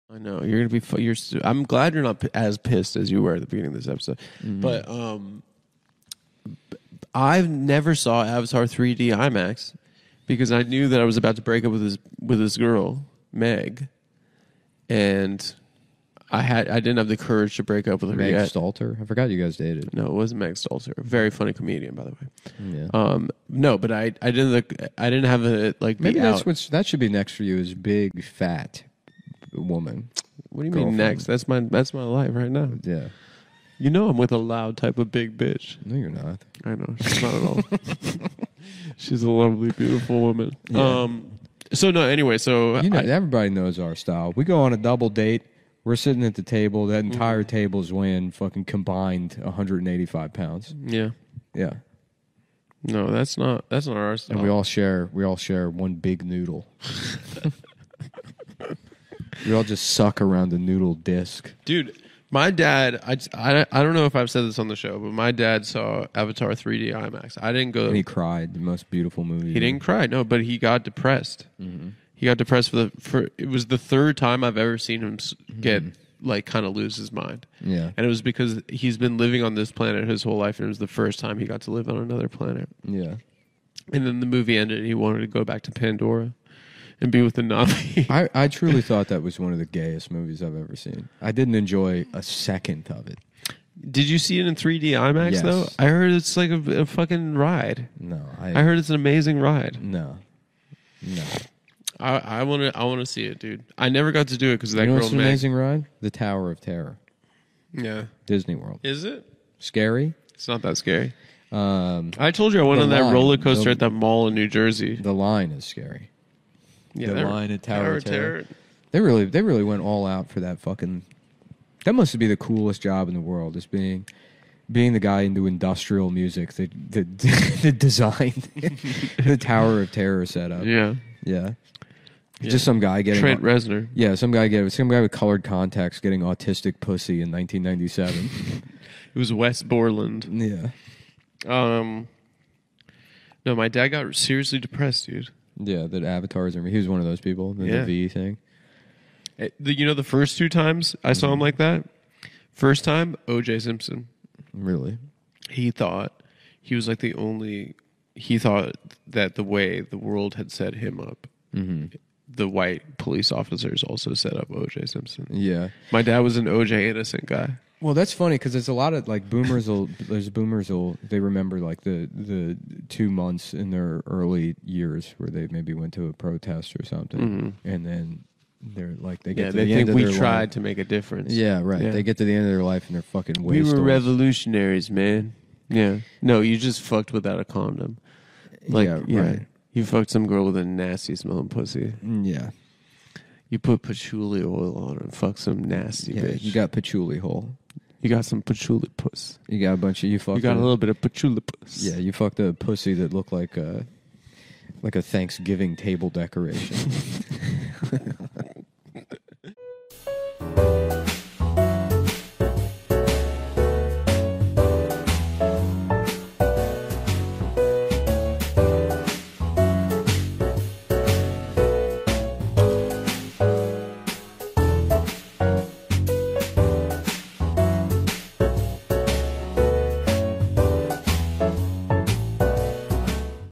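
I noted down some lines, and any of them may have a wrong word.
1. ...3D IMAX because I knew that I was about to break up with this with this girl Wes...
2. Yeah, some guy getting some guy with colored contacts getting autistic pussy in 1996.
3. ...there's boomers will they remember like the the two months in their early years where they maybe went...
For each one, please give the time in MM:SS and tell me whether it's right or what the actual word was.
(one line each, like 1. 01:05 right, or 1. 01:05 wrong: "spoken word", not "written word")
1. 00:08 wrong: "Meg", not "Wes"
2. 02:13 wrong: "1997", not "1996"
3. 02:50 right.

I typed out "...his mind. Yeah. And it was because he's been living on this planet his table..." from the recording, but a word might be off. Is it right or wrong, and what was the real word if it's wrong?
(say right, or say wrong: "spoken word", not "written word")
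wrong: "whole", not "table".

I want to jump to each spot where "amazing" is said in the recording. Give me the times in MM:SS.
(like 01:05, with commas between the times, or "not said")
01:38, 01:45.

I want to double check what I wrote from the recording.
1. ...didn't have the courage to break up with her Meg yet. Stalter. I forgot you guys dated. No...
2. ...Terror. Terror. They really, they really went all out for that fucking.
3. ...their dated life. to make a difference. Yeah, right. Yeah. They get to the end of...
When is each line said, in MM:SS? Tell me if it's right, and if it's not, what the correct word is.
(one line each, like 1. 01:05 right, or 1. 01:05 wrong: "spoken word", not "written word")
1. 00:16 right
2. 01:58 right
3. 03:00 wrong: "tried", not "dated".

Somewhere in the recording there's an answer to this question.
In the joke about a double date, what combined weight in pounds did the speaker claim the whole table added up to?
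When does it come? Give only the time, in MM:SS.
00:49.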